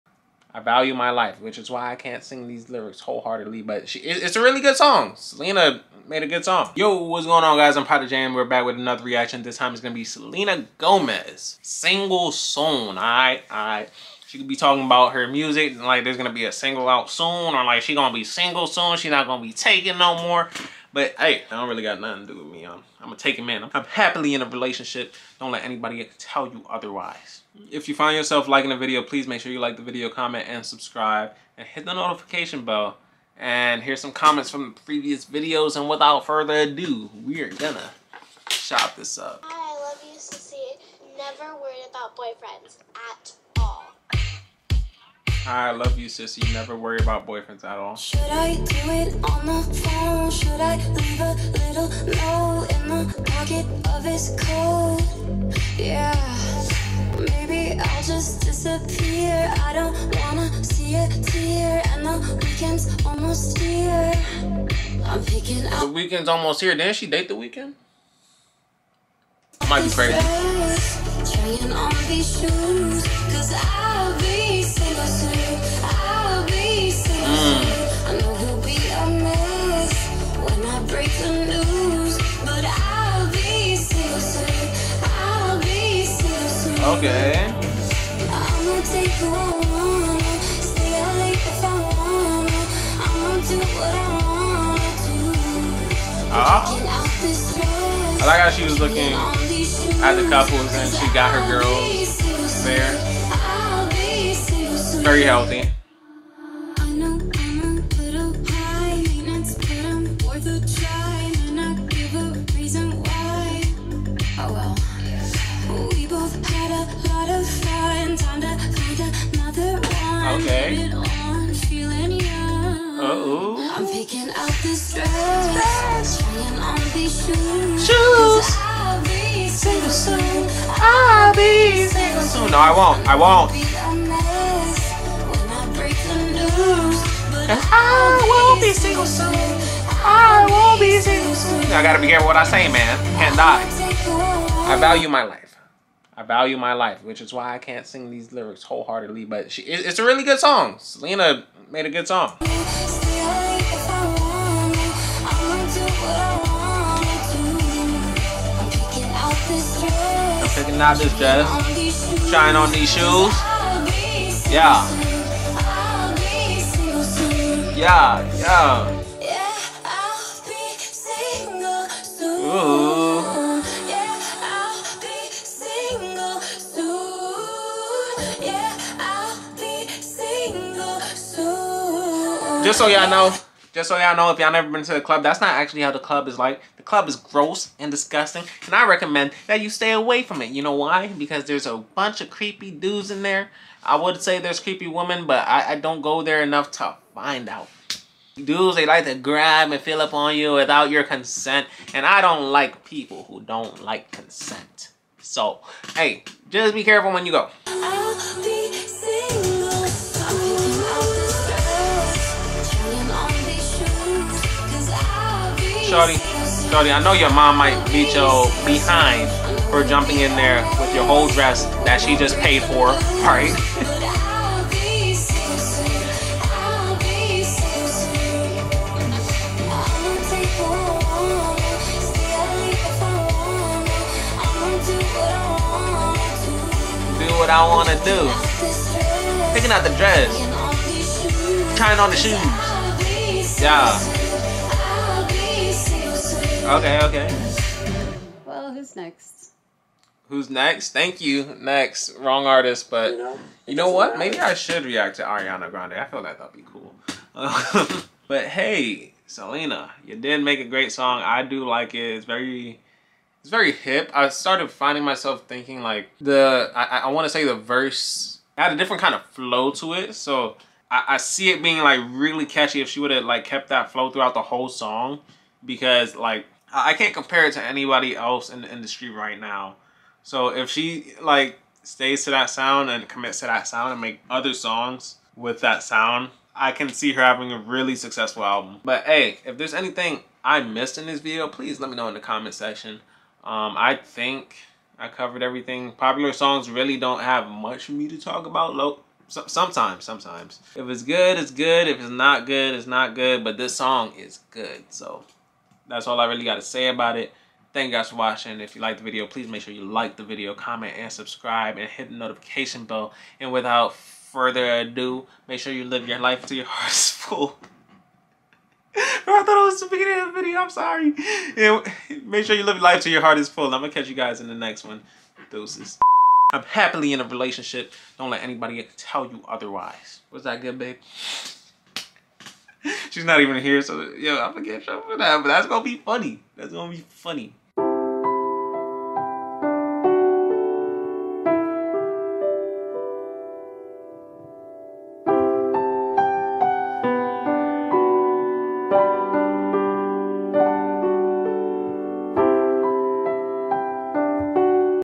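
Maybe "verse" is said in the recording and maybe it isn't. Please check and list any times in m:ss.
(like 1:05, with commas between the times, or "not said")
4:27.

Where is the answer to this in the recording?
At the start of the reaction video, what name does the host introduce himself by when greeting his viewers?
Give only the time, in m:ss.
0:07.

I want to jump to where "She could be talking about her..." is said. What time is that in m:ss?
0:14.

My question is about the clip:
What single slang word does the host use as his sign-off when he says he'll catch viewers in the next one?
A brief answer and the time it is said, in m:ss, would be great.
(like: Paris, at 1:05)
Deuces, at 5:25.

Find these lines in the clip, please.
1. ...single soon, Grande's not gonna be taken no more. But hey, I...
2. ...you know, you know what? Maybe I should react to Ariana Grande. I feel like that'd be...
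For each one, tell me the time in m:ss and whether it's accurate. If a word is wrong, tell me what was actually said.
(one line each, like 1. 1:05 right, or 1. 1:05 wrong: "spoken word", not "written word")
1. 0:18 wrong: "She", not "Grande"
2. 4:13 right.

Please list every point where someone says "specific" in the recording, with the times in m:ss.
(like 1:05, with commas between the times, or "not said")
not said.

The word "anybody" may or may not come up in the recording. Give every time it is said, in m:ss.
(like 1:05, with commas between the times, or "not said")
0:25, 4:37, 5:28.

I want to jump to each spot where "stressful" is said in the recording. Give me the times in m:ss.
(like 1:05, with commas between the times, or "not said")
not said.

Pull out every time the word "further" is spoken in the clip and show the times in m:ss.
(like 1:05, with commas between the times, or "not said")
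0:36, 5:13.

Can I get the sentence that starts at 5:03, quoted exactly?
But this song is good, so that's all I really got to say about it.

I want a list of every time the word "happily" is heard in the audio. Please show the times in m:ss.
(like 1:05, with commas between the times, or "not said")
0:23, 5:26.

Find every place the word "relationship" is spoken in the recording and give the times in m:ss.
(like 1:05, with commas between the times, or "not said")
0:24, 5:27.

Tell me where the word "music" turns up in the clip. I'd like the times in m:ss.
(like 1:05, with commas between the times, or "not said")
0:15.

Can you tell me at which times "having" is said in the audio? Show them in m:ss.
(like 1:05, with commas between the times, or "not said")
4:47.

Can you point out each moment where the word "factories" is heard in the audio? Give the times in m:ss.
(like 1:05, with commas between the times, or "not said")
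not said.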